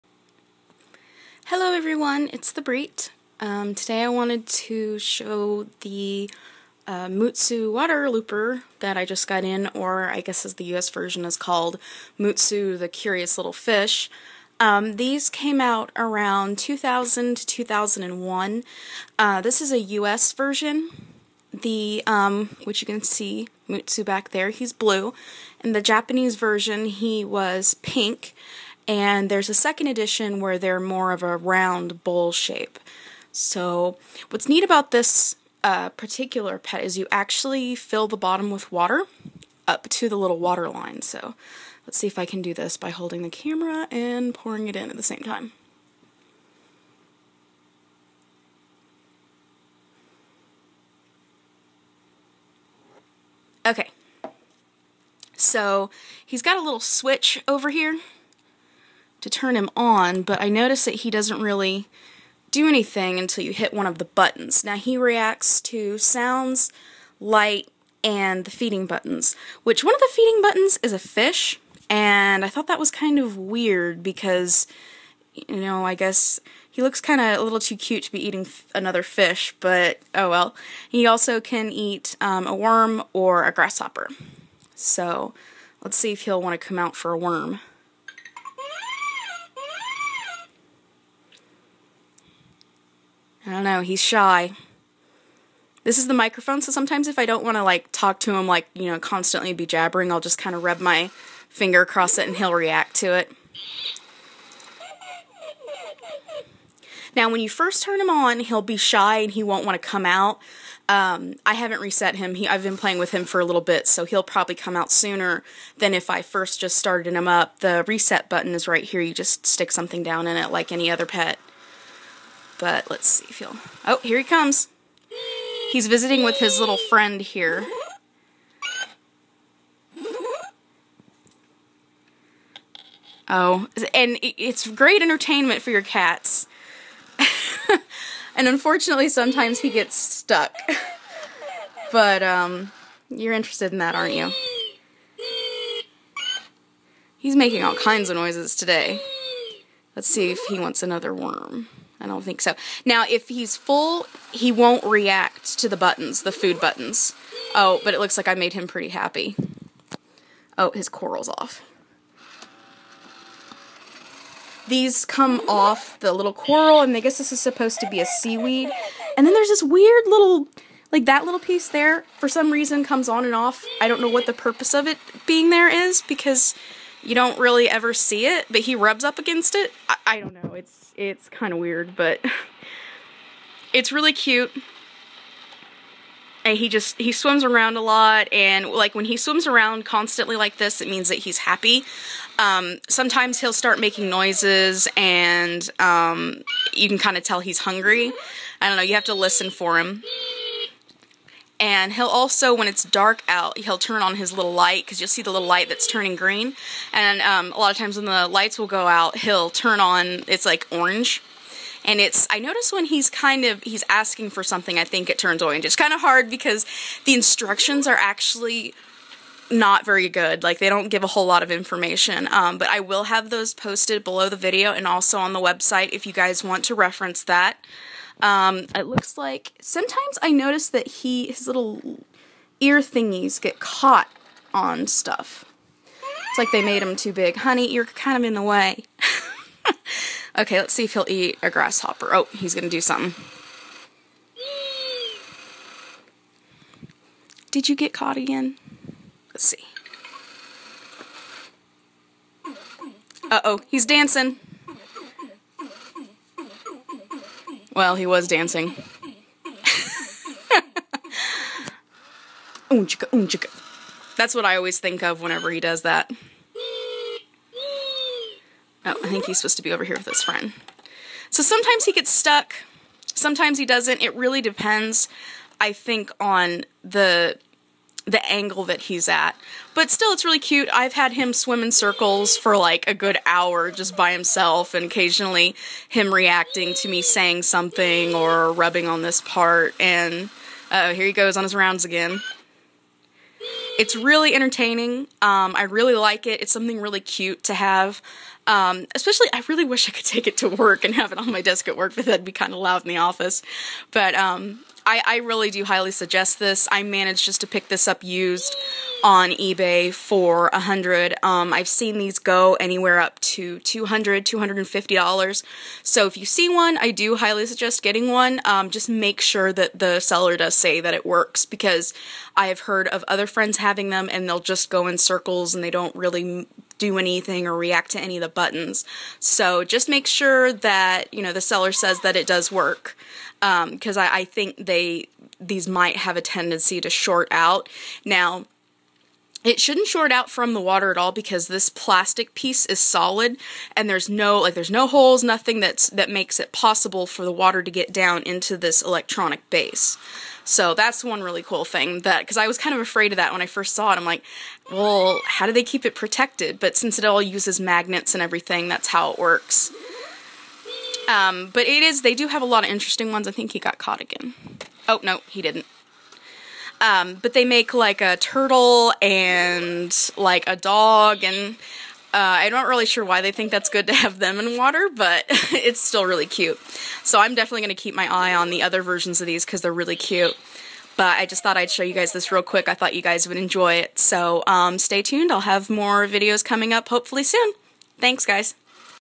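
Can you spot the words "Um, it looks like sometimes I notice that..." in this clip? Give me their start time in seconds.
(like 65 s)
228 s.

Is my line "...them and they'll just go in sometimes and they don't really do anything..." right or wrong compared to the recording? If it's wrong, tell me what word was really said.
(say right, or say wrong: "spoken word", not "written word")
wrong: "circles", not "sometimes".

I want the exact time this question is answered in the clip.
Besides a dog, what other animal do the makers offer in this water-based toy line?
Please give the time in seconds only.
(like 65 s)
368 s.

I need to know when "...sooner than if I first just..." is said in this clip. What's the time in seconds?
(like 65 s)
114 s.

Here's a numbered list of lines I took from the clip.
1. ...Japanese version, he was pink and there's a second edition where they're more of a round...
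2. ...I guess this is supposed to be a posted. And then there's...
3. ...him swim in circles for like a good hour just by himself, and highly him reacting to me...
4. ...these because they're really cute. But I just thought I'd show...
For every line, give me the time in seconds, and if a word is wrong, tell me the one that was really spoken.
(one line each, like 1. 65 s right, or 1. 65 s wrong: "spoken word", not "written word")
1. 25 s right
2. 166 s wrong: "seaweed", not "posted"
3. 281 s wrong: "occasionally", not "highly"
4. 379 s right.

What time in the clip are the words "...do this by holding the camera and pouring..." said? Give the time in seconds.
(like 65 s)
42 s.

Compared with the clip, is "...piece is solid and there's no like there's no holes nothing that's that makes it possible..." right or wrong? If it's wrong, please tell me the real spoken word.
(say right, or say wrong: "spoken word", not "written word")
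right.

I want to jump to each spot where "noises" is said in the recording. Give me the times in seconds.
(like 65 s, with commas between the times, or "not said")
148 s, 194 s.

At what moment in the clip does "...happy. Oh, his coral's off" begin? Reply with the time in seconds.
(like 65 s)
158 s.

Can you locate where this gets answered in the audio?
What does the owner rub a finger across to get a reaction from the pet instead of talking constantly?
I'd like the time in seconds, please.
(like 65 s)
96 s.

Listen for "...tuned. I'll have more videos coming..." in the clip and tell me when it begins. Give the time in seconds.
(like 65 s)
385 s.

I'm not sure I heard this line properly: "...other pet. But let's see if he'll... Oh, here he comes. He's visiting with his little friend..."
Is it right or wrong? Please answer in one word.
right.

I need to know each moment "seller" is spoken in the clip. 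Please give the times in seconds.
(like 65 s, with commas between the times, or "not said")
319 s, 331 s.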